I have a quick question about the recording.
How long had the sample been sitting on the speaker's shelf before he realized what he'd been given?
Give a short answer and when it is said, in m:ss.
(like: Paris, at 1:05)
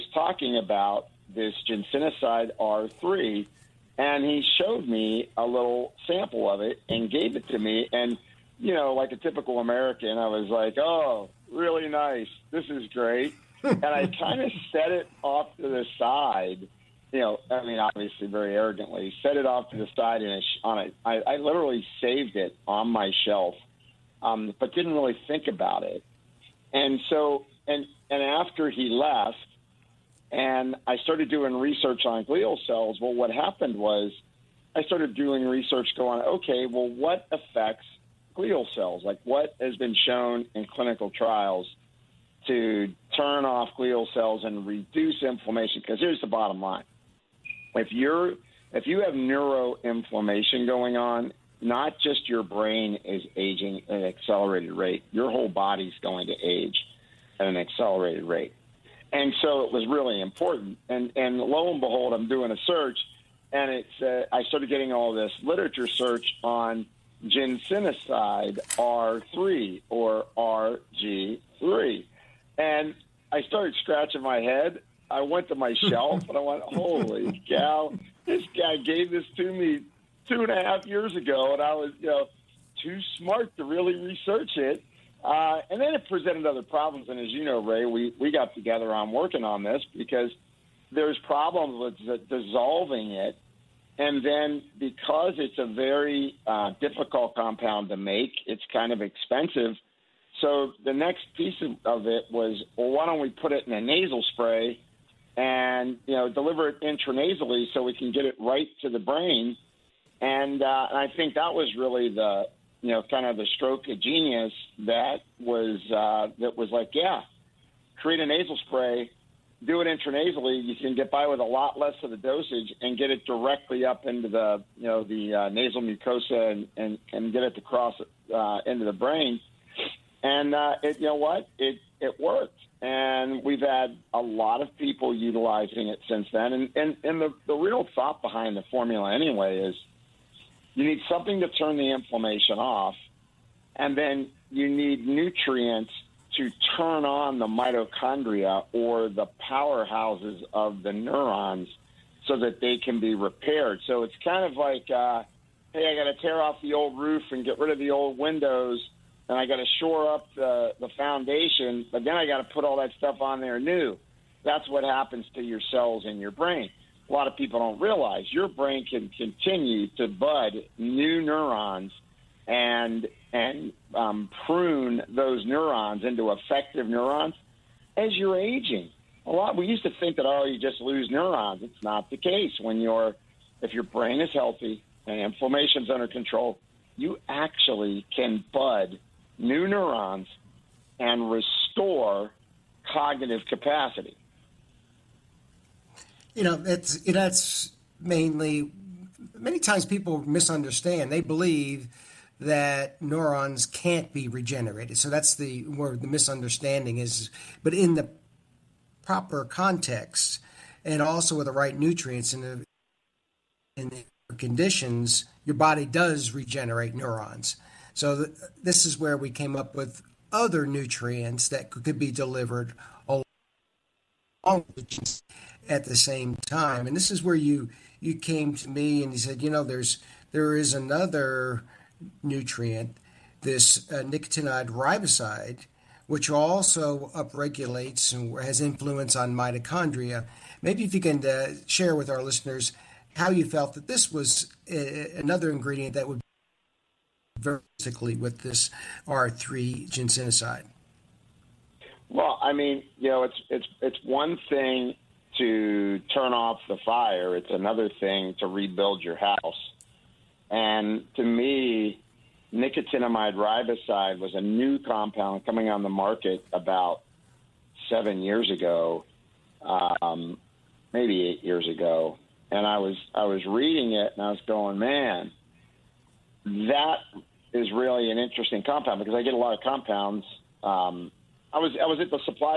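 2.5 years, at 1:20.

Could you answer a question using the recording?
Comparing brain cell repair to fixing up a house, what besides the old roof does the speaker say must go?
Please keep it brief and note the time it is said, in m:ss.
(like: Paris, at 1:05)
old windows, at 2:37.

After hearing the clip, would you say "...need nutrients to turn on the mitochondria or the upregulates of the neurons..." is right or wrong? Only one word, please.
wrong.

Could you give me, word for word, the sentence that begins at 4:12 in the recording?
Well, I mean, you know, it's it's it's one thing to turn off the fire; it's another thing to rebuild your house.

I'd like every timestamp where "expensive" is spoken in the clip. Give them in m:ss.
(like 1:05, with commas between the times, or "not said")
1:38.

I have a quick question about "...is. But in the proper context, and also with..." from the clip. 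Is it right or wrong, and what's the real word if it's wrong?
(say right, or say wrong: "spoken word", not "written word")
right.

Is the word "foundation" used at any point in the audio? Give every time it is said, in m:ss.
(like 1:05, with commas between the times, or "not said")
2:40.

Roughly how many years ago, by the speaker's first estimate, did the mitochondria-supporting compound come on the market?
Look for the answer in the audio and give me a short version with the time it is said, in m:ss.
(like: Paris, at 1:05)
7, at 4:27.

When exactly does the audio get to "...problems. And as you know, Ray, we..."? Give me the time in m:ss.
1:26.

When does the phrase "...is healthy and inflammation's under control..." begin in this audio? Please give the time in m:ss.
3:04.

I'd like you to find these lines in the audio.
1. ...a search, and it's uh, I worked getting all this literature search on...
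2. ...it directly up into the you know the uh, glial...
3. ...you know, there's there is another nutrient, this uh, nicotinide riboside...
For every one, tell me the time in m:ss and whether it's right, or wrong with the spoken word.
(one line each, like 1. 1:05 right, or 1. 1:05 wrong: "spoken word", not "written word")
1. 1:02 wrong: "started", not "worked"
2. 2:03 wrong: "nasal", not "glial"
3. 3:49 right.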